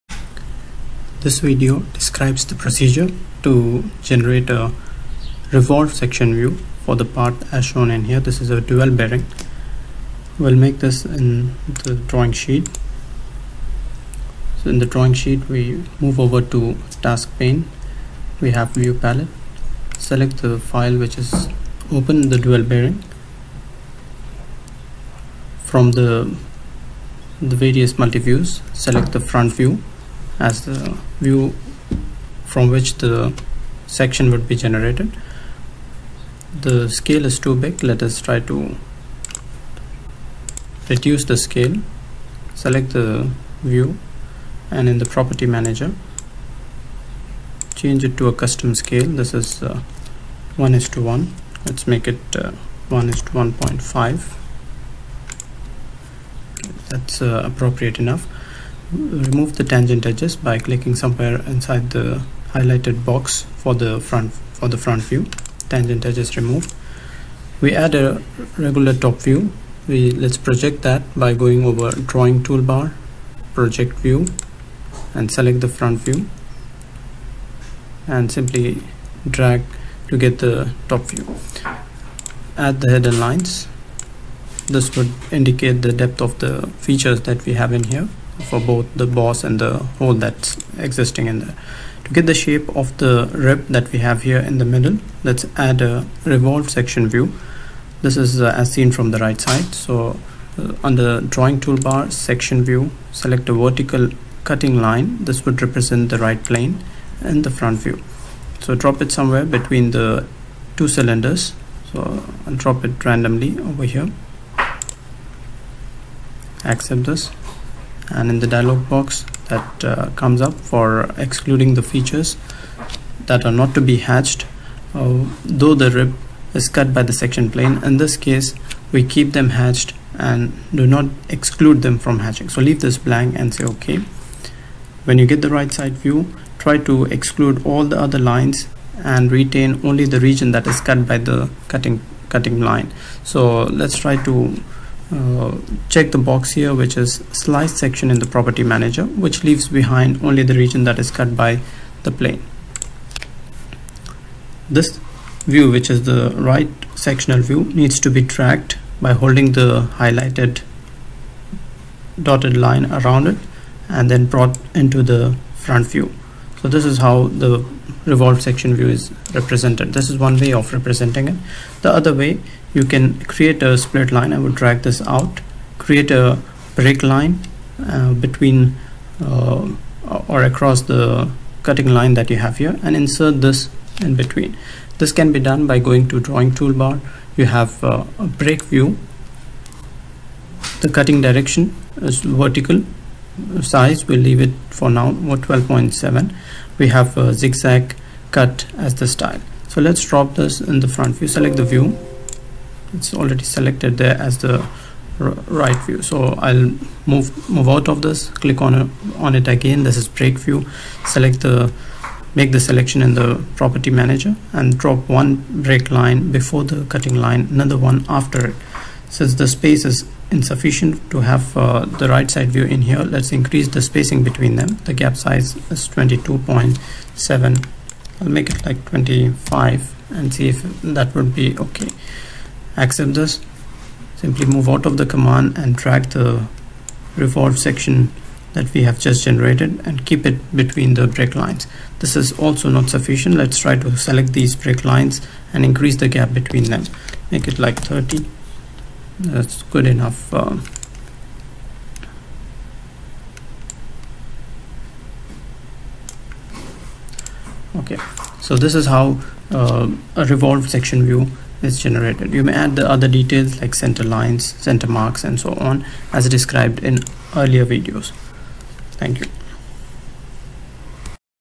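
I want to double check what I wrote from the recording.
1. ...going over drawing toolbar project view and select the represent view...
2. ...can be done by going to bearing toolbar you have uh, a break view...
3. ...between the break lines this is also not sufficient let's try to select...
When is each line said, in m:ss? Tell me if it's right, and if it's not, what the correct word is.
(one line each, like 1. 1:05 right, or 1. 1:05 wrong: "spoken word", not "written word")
1. 1:11 wrong: "front", not "represent"
2. 3:05 wrong: "drawing", not "bearing"
3. 4:00 right.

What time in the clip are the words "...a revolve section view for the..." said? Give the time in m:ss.
0:04.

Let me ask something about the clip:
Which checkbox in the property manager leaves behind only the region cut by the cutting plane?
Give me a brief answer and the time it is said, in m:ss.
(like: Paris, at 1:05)
Slice section, at 2:27.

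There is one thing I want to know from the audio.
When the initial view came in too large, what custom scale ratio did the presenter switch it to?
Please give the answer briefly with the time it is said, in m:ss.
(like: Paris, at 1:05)
1:1.5, at 0:52.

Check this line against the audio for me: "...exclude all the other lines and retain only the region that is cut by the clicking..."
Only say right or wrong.
wrong.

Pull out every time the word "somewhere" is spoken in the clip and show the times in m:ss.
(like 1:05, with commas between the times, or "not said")
1:00, 1:49.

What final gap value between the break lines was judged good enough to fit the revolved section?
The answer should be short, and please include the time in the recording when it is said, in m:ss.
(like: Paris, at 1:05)
30, at 4:07.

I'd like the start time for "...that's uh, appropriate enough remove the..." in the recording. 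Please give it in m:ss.
0:56.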